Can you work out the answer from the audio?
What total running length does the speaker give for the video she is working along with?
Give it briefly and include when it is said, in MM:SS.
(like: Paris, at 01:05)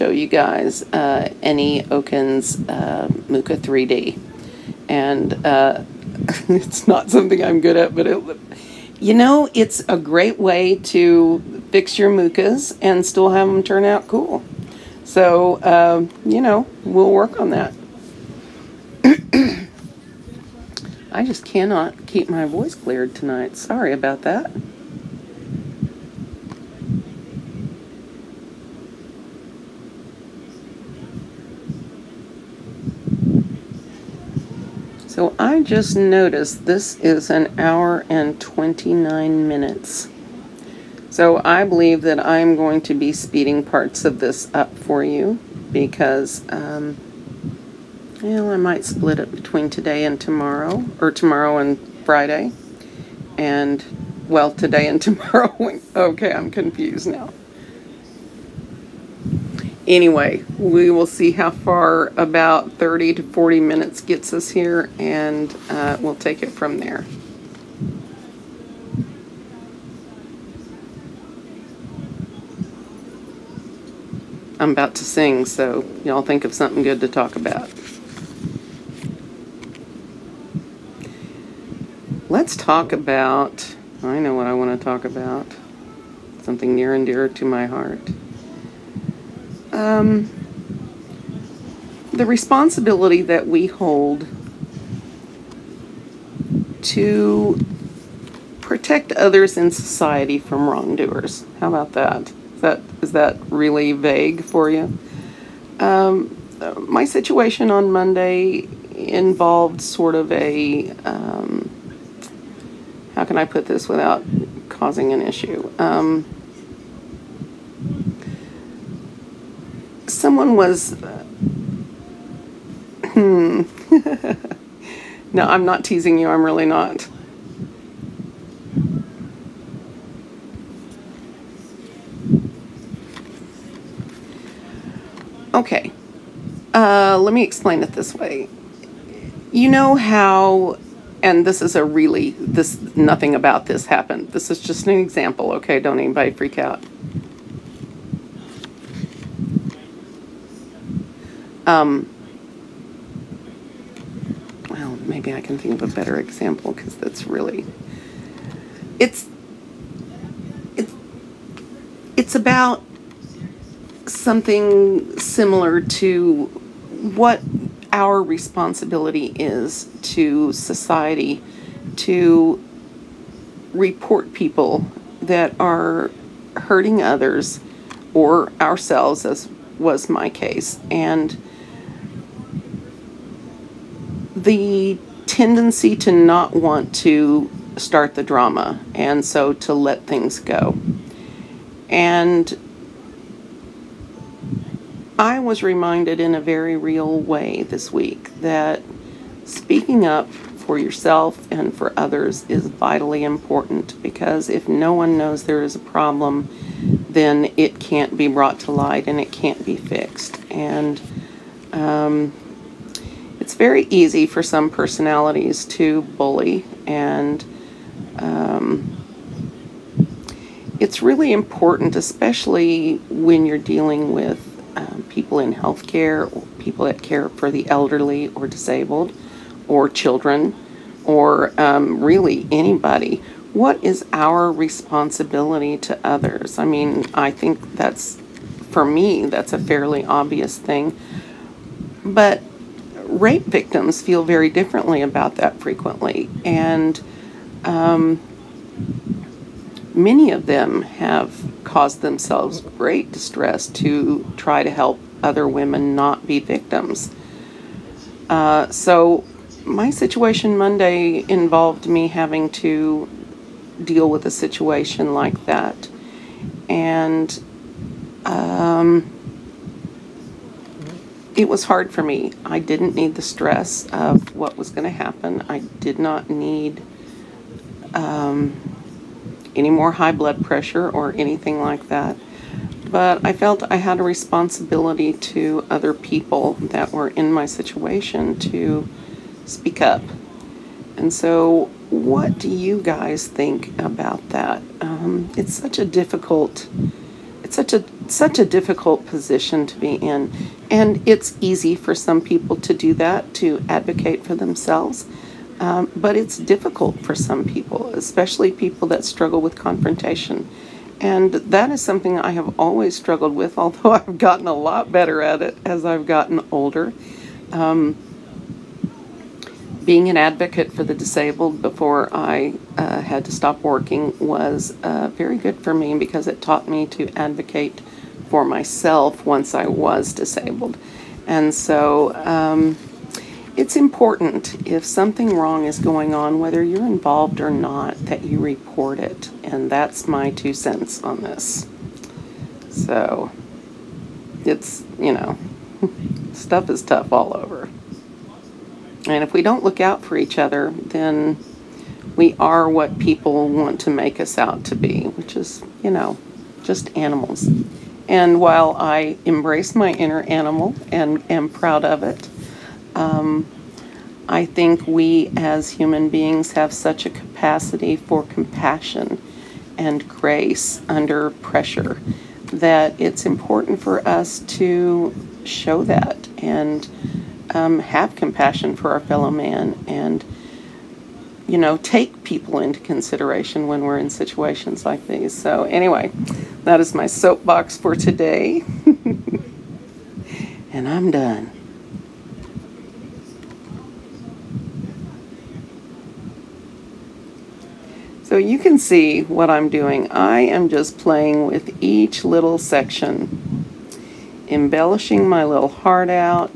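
1 hour 29 minutes, at 00:37.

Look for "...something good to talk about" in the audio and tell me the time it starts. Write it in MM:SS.
01:16.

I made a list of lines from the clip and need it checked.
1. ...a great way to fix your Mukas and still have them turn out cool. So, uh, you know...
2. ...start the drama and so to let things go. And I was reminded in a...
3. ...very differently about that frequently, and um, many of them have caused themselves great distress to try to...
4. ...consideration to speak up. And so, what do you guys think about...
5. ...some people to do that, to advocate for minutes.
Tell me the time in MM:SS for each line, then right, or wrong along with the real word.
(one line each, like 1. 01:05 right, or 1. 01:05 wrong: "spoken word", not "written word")
1. 00:09 right
2. 03:07 right
3. 04:04 right
4. 04:47 wrong: "situation", not "consideration"
5. 05:01 wrong: "themselves", not "minutes".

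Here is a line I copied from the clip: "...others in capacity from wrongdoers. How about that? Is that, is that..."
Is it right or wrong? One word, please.
wrong.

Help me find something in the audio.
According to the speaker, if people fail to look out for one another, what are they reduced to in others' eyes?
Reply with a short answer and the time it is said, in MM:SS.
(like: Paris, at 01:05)
just animals, at 05:56.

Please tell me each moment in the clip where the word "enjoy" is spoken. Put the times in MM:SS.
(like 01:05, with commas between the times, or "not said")
not said.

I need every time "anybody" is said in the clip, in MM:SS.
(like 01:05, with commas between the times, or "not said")
02:25, 03:52.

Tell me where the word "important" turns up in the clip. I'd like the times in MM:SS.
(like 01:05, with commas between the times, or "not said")
03:23, 03:41, 05:33, 06:13.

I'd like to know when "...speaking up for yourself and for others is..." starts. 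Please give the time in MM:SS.
03:19.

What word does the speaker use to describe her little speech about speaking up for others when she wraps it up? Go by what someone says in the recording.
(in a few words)
soapbox.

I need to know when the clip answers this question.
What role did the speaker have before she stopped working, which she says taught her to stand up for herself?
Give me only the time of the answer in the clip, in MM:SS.
05:20.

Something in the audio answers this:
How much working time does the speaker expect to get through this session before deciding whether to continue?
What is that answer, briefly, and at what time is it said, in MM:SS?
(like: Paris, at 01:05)
30 to 40 minutes, at 01:02.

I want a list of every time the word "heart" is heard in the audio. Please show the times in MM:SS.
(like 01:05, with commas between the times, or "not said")
01:27, 06:45.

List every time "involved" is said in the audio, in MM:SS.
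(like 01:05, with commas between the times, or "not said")
01:48, 04:21, 05:36.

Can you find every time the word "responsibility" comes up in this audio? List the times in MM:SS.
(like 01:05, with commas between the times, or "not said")
01:32, 02:48, 03:54, 04:44.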